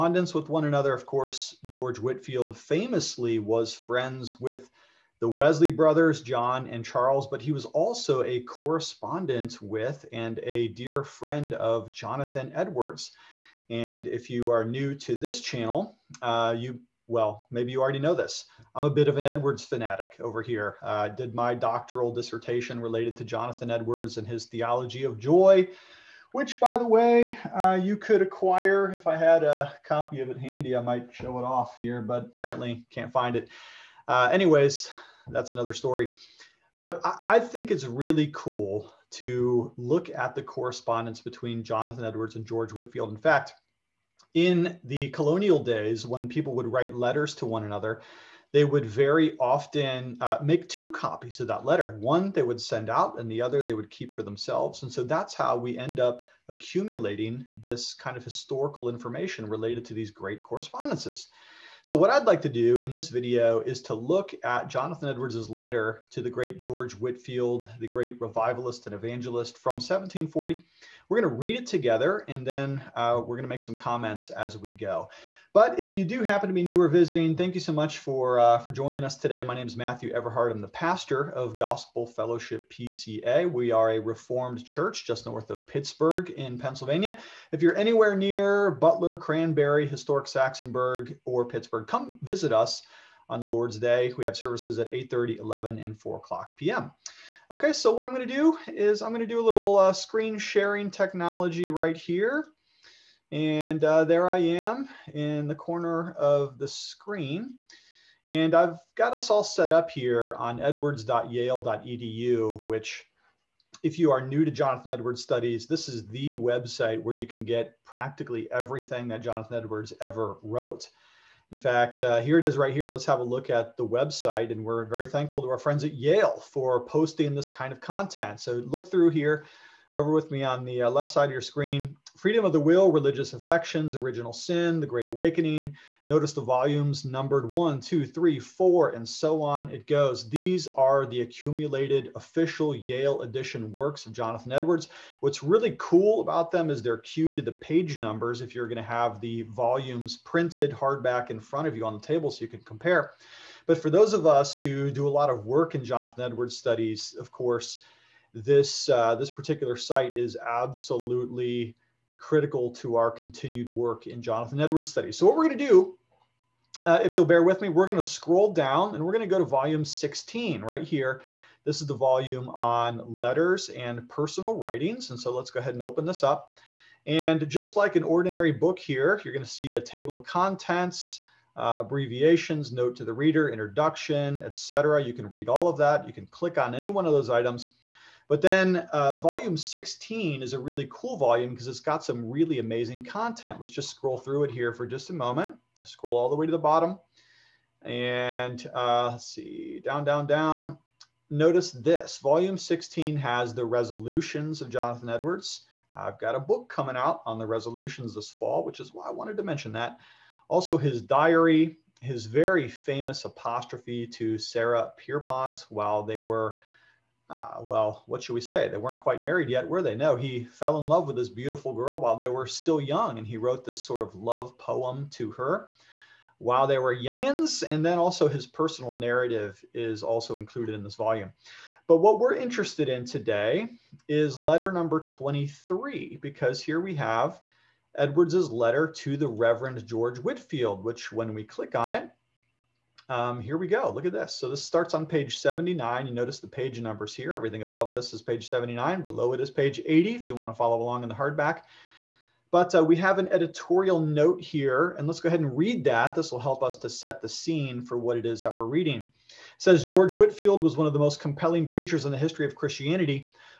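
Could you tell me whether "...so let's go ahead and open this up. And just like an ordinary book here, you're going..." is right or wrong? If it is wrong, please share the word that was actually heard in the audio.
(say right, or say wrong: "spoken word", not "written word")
right.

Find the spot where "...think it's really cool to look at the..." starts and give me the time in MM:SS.
00:37.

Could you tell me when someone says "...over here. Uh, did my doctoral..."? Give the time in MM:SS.
00:20.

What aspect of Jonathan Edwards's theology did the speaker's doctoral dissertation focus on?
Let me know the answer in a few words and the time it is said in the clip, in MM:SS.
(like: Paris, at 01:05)
joy, at 00:25.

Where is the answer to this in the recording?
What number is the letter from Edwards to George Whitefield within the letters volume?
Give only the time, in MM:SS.
03:55.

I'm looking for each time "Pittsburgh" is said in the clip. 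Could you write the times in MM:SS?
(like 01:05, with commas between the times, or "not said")
01:25, 01:31.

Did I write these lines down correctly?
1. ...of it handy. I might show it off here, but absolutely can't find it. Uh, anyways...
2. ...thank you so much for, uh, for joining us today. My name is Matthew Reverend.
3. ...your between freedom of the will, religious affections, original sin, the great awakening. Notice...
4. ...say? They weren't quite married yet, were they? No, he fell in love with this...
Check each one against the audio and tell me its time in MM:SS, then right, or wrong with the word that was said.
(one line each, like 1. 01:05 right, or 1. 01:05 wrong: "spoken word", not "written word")
1. 00:30 wrong: "apparently", not "absolutely"
2. 01:17 wrong: "Everhard", not "Reverend"
3. 02:11 wrong: "screen", not "between"
4. 03:38 right.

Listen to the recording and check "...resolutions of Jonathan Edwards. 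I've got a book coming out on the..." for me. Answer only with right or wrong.
right.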